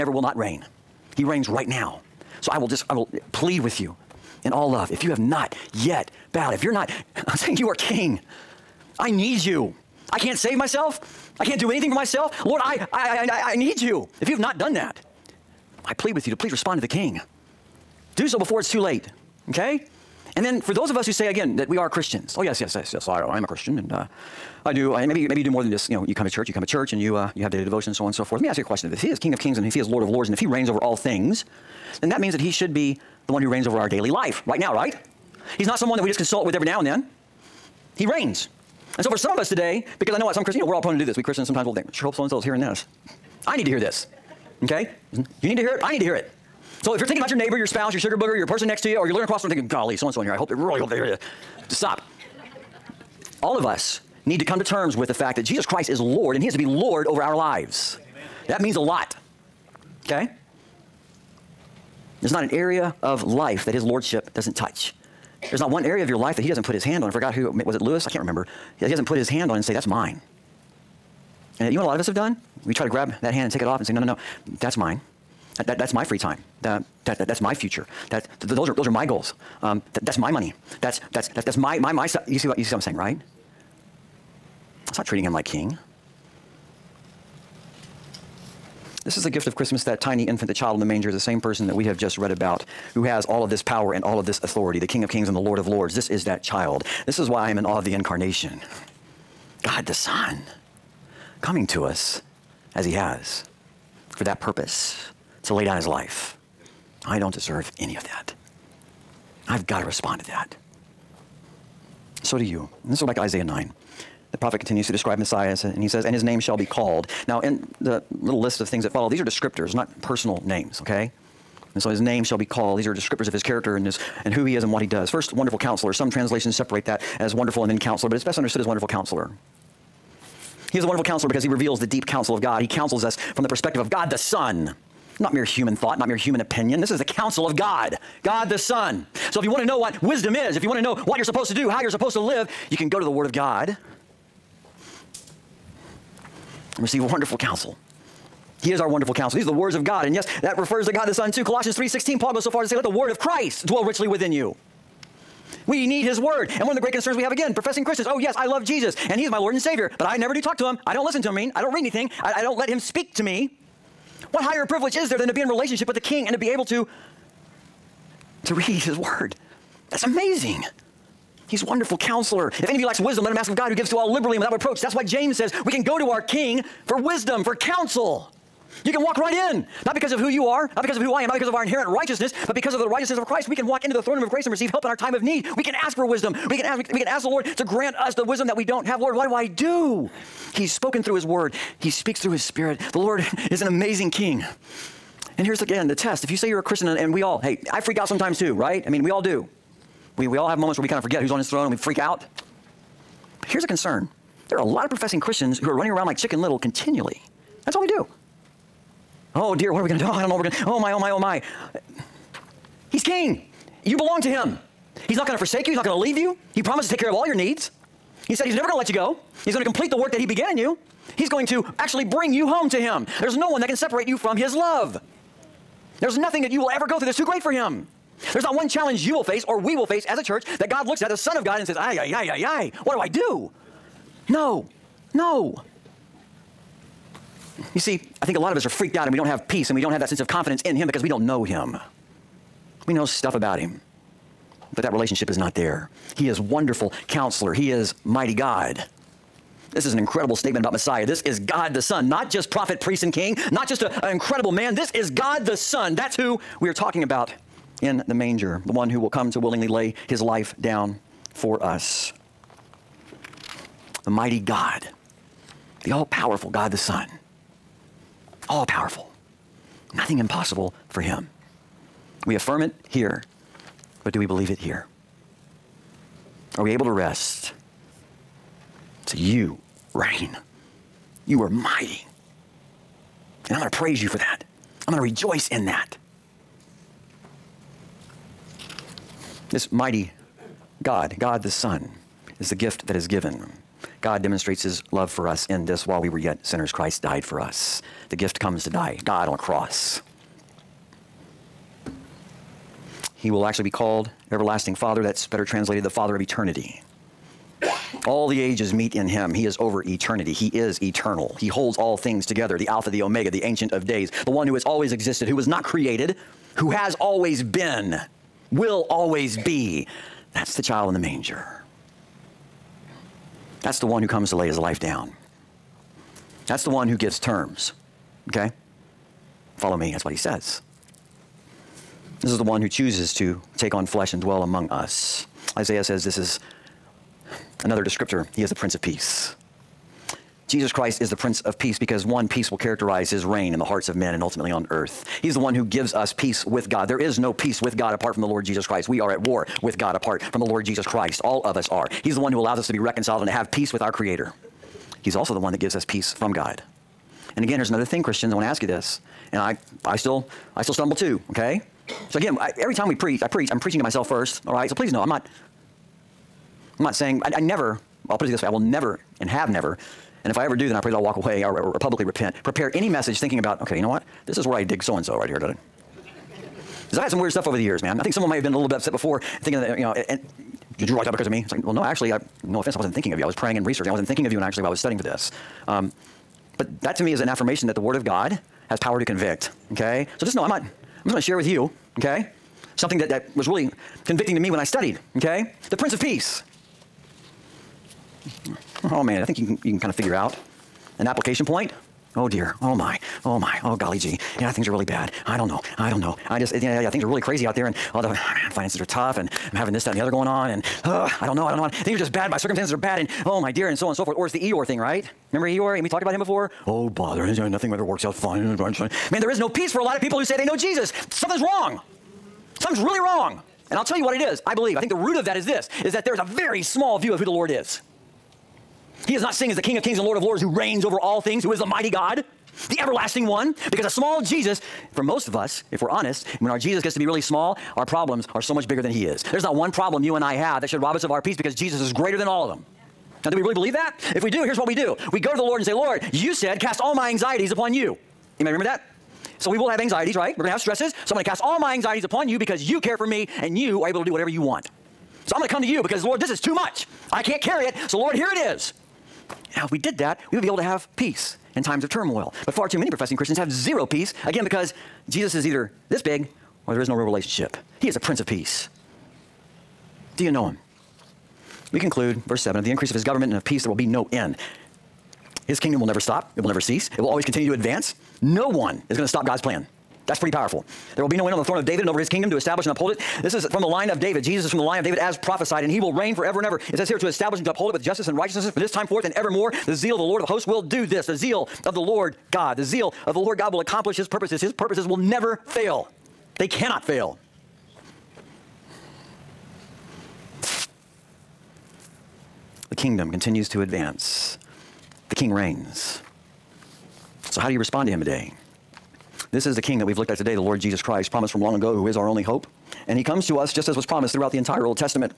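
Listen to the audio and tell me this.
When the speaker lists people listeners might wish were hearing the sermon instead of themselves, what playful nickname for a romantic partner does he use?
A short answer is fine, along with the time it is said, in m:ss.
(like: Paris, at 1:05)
sugar booger, at 0:47.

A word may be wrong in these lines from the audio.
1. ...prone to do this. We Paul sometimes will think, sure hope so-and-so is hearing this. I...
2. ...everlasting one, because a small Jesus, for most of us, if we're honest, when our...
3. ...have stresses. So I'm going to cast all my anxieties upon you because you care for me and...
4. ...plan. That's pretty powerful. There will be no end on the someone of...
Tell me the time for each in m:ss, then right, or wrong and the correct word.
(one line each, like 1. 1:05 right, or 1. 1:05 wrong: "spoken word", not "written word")
1. 0:40 wrong: "Christians", not "Paul"
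2. 7:12 right
3. 7:30 right
4. 7:59 wrong: "throne", not "someone".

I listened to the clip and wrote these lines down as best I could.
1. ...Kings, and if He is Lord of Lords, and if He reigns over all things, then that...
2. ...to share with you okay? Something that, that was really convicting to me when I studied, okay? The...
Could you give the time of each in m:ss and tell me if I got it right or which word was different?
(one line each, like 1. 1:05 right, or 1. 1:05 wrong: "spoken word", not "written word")
1. 0:29 right
2. 6:31 right.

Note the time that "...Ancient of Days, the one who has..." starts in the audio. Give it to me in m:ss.
5:13.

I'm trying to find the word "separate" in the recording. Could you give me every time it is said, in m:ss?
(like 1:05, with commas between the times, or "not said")
2:06, 3:43.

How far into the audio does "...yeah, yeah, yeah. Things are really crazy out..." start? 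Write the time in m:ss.
6:46.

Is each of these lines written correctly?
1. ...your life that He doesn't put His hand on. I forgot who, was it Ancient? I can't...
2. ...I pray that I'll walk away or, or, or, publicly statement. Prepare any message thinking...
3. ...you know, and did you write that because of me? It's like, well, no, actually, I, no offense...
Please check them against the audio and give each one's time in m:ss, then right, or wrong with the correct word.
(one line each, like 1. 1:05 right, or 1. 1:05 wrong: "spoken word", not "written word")
1. 1:06 wrong: "Lewis", not "Ancient"
2. 6:10 wrong: "repent", not "statement"
3. 6:19 right.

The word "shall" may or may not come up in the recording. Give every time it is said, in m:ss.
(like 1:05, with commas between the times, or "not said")
1:56, 2:02.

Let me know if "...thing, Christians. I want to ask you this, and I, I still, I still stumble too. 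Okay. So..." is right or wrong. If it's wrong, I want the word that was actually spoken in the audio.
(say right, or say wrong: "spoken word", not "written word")
right.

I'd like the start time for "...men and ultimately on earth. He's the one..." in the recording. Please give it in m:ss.
5:43.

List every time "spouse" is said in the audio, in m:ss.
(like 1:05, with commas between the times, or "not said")
0:47.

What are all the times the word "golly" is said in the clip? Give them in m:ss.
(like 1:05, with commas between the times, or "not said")
0:49, 6:43.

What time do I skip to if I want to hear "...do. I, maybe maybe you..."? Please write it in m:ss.
0:24.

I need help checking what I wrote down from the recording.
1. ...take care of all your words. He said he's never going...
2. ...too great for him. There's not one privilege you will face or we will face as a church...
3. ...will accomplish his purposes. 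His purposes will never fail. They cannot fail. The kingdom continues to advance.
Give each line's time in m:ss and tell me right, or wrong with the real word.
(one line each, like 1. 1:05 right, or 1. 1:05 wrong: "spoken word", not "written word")
1. 3:36 wrong: "needs", not "words"
2. 3:47 wrong: "challenge", not "privilege"
3. 8:13 right.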